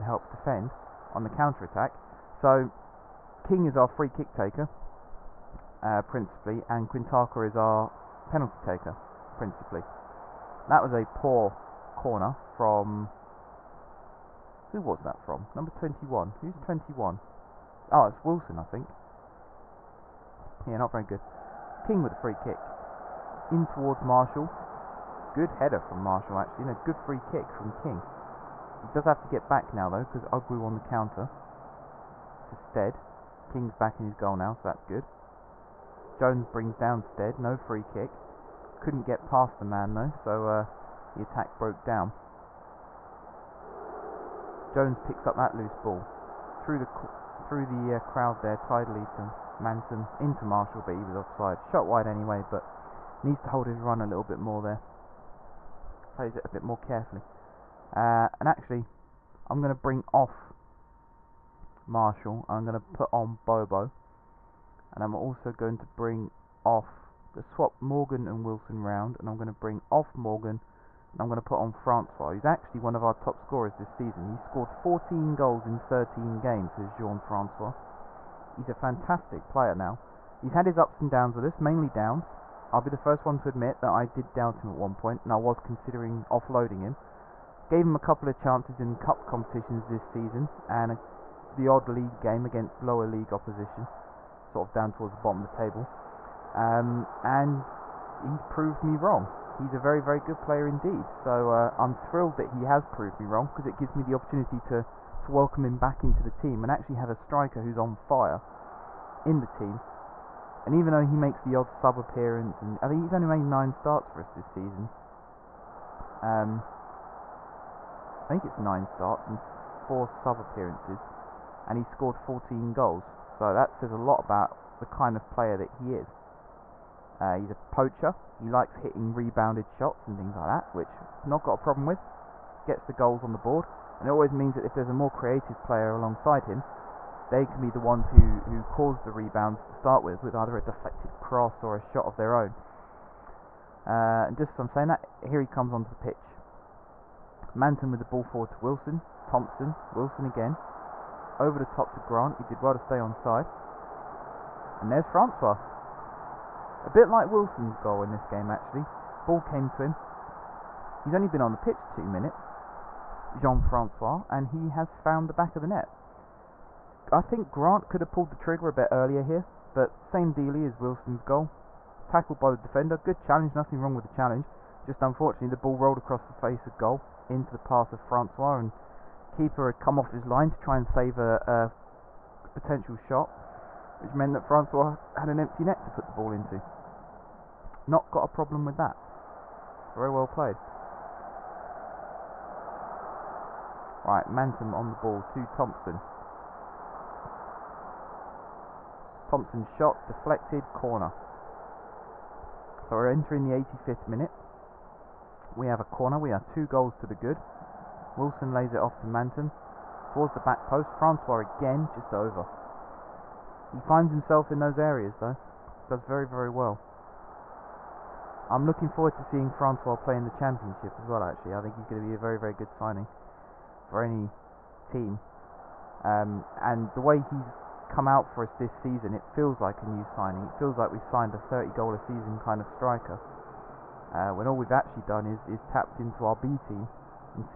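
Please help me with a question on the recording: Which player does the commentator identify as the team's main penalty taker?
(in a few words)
Quintaka.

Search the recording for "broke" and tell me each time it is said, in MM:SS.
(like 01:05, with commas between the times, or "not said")
00:41.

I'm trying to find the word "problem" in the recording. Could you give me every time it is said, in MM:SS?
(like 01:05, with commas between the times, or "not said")
02:11, 03:08.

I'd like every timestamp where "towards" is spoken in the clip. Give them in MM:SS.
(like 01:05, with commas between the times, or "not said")
00:23, 01:34, 03:30.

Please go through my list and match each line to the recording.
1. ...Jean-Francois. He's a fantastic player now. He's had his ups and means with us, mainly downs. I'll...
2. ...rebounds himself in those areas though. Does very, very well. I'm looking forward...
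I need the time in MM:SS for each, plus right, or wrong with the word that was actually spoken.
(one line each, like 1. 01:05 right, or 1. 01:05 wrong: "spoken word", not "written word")
1. 01:16 wrong: "downs", not "means"
2. 03:33 wrong: "finds", not "rebounds".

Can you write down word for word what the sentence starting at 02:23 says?
Uh, and just as I'm saying that, here he comes onto the pitch.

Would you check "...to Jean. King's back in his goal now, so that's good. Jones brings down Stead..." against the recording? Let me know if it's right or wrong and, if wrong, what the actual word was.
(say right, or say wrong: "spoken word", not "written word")
wrong: "Stead", not "Jean".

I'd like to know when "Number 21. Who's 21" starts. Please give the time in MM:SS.
00:15.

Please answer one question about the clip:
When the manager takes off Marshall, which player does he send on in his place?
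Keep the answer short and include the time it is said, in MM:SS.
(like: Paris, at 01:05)
Bobo, at 01:03.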